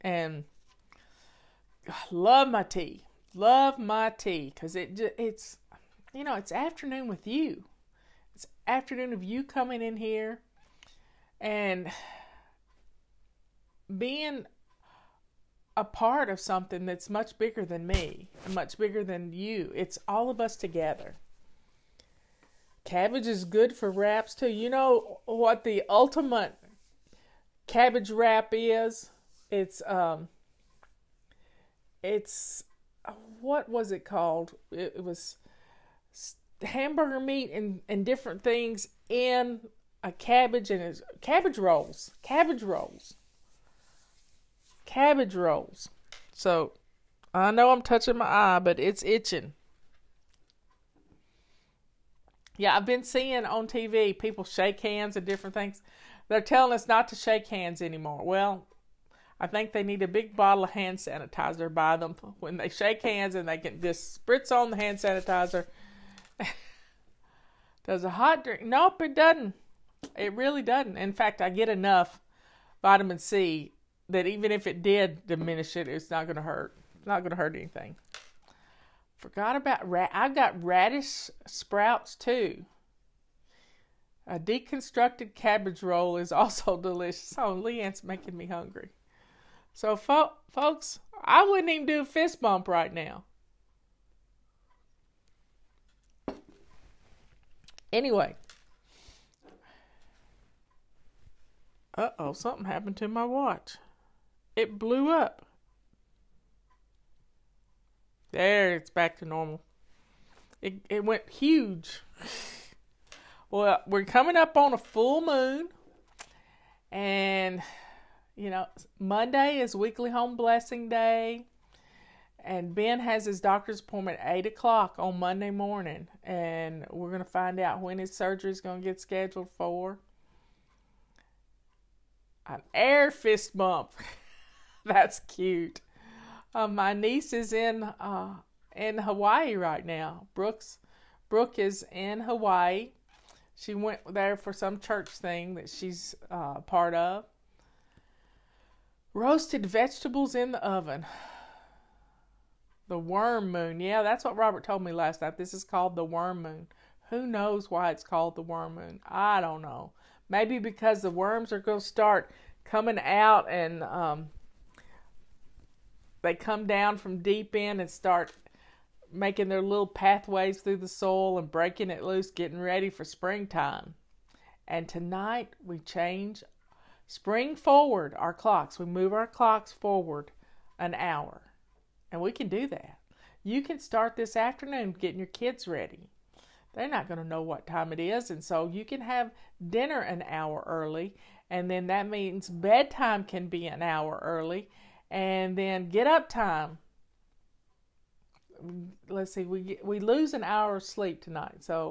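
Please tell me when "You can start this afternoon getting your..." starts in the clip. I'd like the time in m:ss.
3:03.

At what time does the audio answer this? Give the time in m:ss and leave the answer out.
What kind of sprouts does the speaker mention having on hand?
1:20.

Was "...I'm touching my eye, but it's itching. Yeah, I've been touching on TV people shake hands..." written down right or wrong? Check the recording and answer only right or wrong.
wrong.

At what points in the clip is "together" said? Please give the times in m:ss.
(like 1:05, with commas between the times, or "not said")
0:20.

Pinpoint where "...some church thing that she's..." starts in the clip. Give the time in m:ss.
2:24.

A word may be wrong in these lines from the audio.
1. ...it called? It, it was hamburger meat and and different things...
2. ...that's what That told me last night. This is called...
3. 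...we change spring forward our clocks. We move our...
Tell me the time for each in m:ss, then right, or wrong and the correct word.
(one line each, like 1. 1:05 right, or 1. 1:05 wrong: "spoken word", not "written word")
1. 0:33 right
2. 2:34 wrong: "Robert", not "That"
3. 2:55 right.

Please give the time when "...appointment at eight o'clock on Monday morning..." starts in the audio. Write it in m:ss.
2:03.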